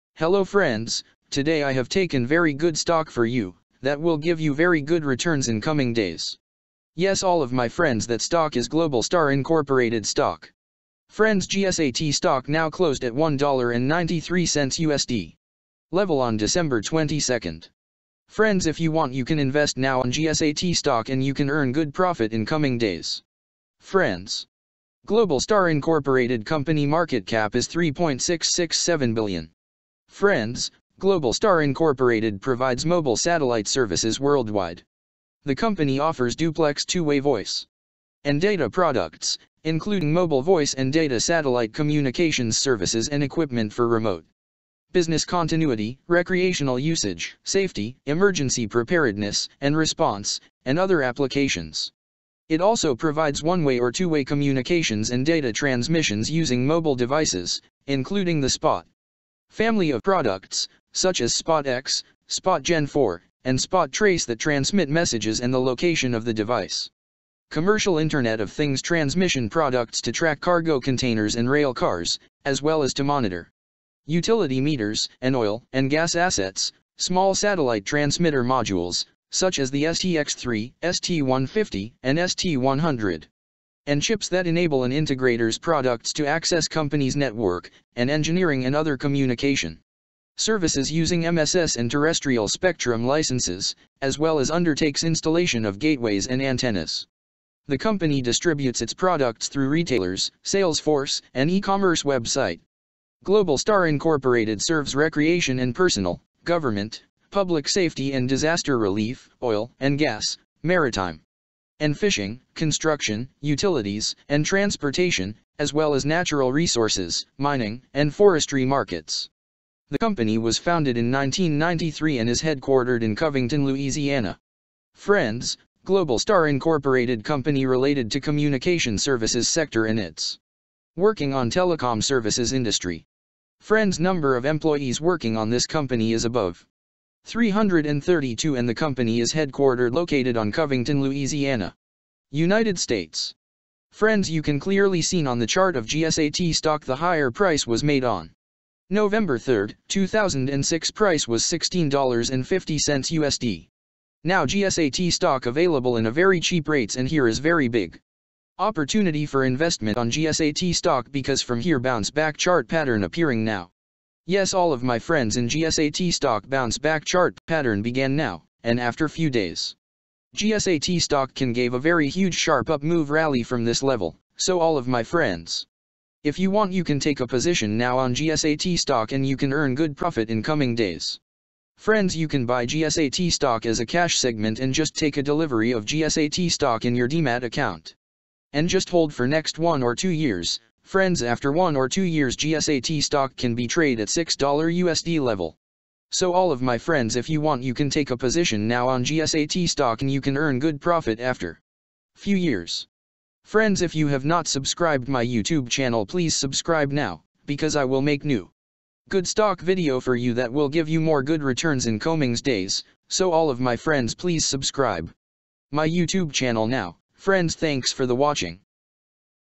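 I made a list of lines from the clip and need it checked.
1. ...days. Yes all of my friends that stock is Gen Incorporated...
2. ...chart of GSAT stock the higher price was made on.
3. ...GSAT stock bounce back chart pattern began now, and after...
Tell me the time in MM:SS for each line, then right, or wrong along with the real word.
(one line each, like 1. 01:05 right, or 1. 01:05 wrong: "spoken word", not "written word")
1. 00:05 wrong: "Globalstar", not "Gen"
2. 02:25 right
3. 02:45 right.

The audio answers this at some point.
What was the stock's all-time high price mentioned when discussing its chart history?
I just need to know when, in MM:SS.
02:31.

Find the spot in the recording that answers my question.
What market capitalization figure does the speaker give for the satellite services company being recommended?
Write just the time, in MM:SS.
00:27.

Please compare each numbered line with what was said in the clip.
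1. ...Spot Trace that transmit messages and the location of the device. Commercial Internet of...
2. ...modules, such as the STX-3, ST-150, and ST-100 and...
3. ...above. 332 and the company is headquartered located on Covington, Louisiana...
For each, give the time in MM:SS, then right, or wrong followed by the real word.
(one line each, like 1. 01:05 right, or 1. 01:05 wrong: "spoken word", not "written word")
1. 01:03 right
2. 01:18 right
3. 02:16 right.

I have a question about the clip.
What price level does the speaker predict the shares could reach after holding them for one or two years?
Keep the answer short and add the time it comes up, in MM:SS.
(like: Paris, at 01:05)
$6, at 03:14.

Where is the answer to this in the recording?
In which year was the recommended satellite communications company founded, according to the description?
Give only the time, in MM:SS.
02:01.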